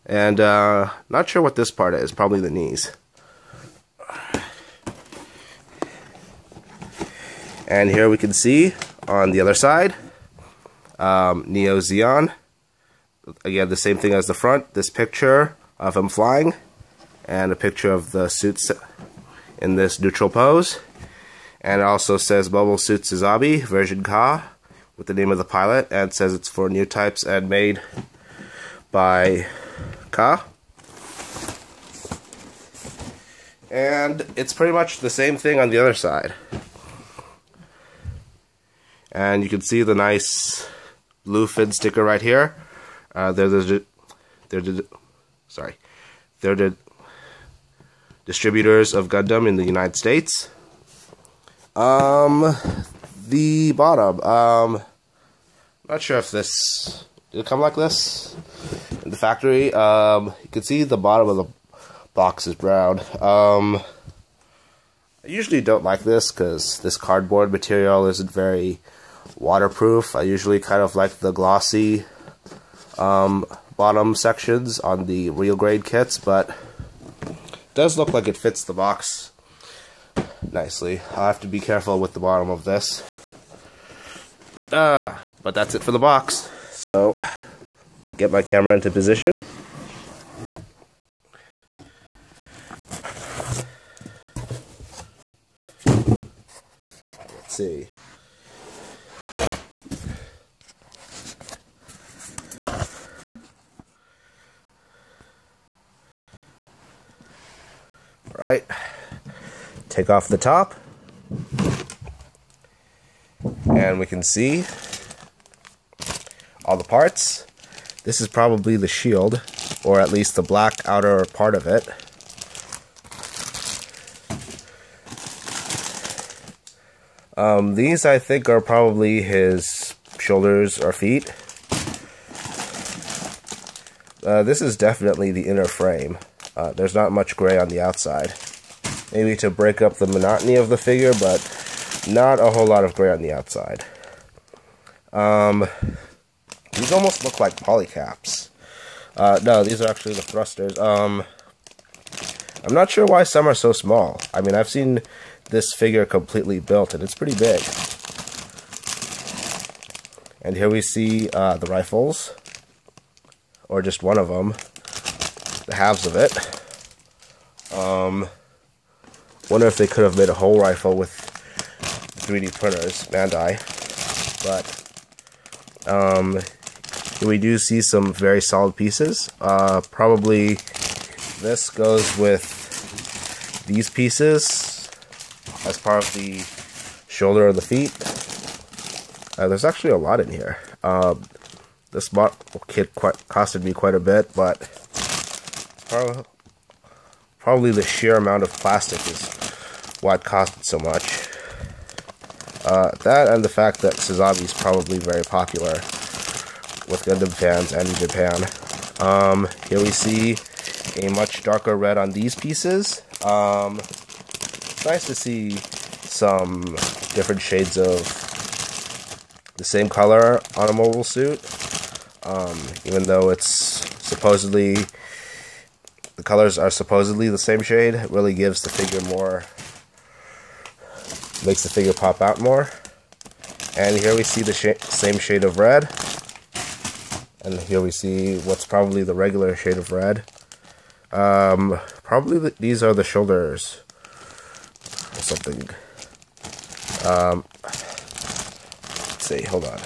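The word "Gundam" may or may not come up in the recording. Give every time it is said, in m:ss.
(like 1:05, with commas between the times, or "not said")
0:49, 3:27.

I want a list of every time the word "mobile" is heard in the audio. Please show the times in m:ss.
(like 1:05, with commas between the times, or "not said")
0:22, 3:40.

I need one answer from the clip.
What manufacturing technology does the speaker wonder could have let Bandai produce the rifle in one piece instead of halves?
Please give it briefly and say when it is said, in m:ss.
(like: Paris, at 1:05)
3D printers, at 2:52.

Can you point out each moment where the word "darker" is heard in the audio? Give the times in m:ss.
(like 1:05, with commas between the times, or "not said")
3:31.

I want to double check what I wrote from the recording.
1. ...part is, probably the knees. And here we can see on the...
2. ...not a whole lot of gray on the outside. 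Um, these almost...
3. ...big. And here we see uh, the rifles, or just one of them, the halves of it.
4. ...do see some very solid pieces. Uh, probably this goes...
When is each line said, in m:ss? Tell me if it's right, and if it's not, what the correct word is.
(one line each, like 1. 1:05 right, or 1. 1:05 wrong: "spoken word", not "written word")
1. 0:01 right
2. 2:22 right
3. 2:37 right
4. 2:57 right.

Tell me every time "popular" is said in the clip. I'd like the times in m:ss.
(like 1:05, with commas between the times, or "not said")
3:25.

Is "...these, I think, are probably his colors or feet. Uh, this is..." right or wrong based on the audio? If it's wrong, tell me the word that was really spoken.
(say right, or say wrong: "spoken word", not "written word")
wrong: "shoulders", not "colors".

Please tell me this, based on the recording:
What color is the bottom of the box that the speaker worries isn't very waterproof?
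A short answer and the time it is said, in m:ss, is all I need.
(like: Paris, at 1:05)
Brown, at 1:02.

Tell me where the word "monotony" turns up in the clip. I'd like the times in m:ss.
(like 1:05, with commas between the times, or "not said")
2:20.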